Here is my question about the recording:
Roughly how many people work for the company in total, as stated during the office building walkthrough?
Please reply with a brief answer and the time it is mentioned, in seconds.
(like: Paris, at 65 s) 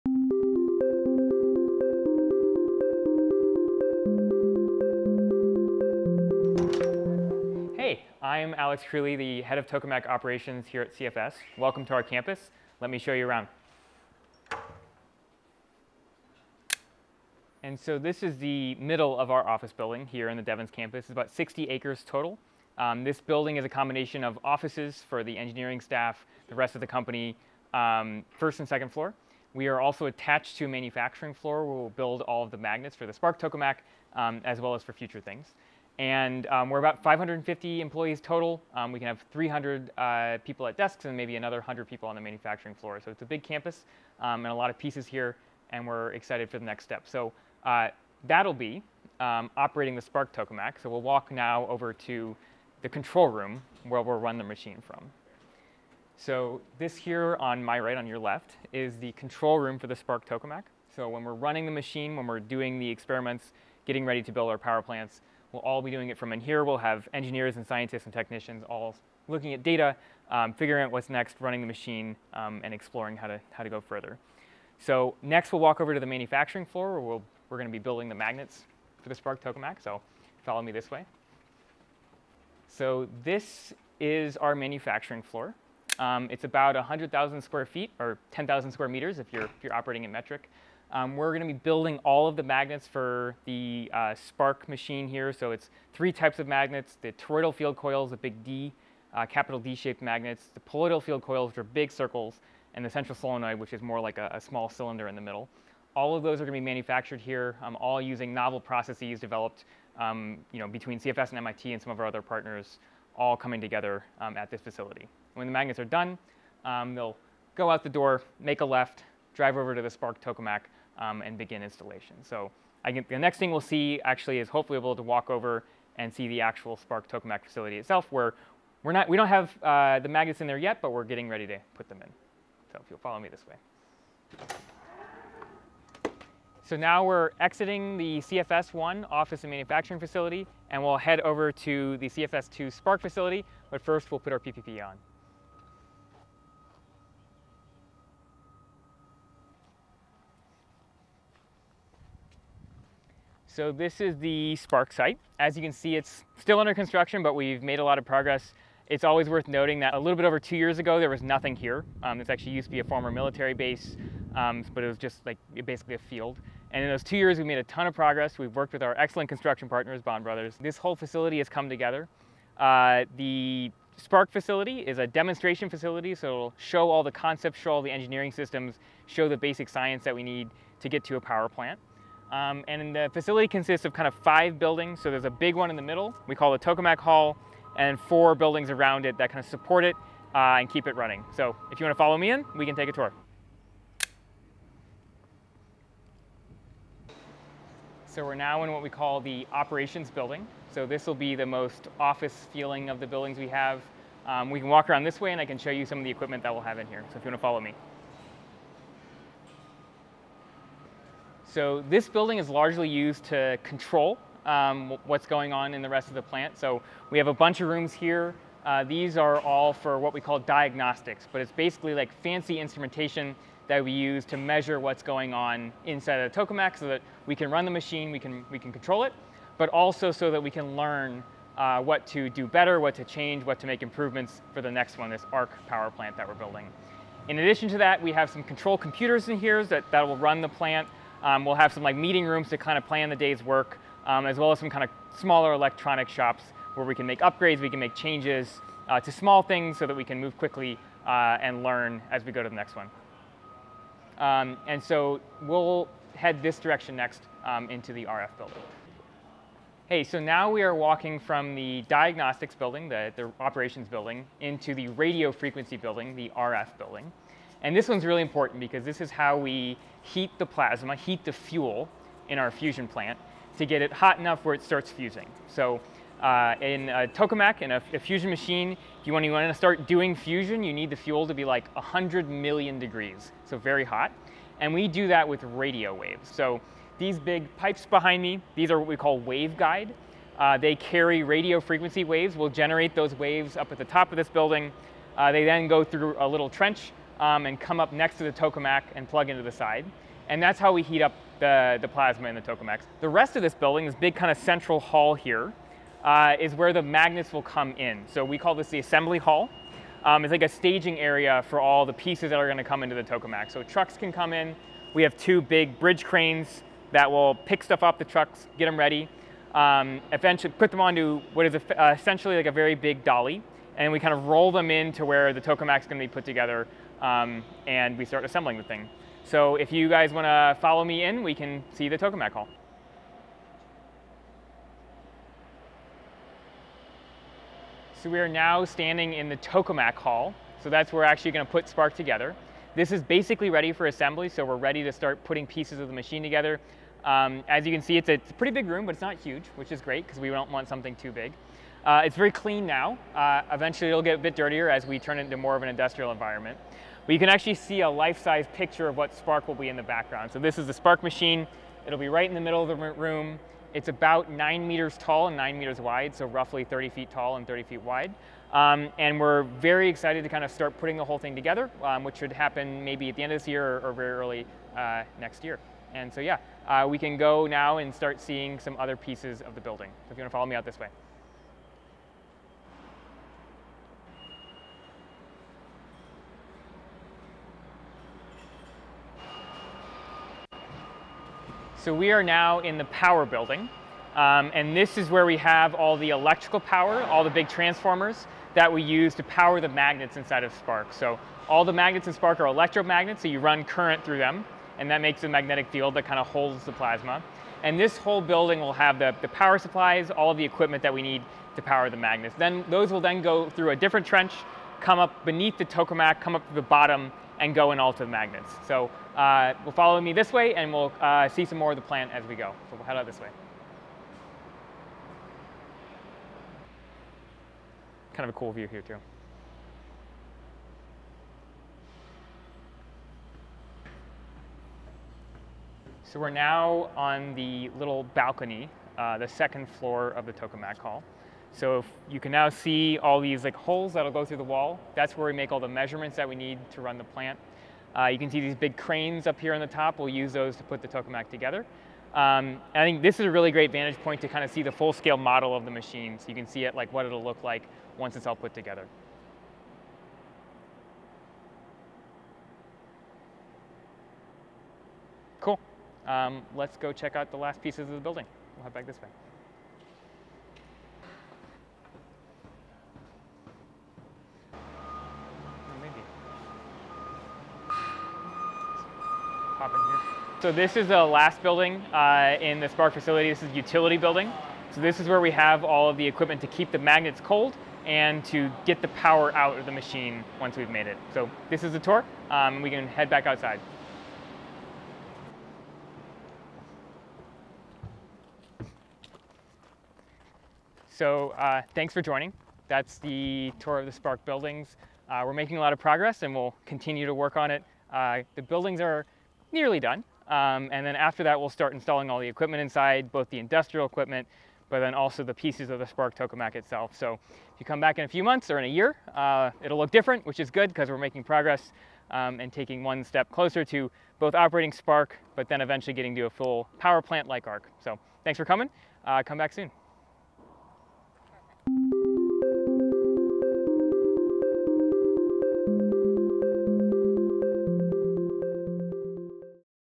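550, at 37 s.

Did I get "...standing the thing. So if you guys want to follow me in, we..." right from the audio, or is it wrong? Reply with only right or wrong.
wrong.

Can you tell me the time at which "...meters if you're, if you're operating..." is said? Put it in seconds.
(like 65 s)
88 s.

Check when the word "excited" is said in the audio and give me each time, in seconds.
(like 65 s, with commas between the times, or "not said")
46 s, 369 s.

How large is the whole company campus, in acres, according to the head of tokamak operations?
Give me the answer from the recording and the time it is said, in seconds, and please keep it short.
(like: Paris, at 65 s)
60 acres, at 21 s.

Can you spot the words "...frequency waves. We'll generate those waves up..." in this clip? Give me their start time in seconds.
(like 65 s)
291 s.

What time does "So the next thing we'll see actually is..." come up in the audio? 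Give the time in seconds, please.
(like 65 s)
122 s.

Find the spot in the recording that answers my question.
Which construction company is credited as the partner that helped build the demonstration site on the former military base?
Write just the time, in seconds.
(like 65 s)
170 s.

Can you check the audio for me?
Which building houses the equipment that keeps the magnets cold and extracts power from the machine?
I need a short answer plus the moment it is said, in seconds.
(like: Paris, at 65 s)
Utility building, at 483 s.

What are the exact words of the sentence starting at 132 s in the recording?
So if you'll follow me this way.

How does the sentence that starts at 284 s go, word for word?
And we do that with radio waves.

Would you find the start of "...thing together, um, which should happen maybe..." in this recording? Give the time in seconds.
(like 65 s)
371 s.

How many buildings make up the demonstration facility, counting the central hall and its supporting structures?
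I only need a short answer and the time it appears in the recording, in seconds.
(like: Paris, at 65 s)
5, at 184 s.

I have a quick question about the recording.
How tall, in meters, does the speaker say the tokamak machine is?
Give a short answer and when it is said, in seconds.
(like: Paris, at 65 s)
9 meters, at 364 s.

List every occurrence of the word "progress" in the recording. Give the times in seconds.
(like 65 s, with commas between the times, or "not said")
158 s, 167 s, 505 s, 521 s.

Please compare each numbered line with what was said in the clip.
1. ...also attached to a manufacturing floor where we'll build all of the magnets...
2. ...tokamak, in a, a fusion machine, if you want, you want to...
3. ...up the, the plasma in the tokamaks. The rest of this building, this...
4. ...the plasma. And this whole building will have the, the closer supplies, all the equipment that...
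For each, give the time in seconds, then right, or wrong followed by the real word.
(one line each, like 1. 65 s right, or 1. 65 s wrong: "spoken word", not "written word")
1. 29 s right
2. 277 s right
3. 301 s right
4. 406 s wrong: "power", not "closer".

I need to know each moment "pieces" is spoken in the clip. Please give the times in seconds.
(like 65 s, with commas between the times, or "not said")
44 s, 311 s, 345 s, 378 s, 467 s, 515 s.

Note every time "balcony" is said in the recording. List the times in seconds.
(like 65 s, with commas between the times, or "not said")
438 s.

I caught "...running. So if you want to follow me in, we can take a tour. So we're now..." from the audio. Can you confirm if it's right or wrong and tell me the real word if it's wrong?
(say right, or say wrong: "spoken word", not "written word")
right.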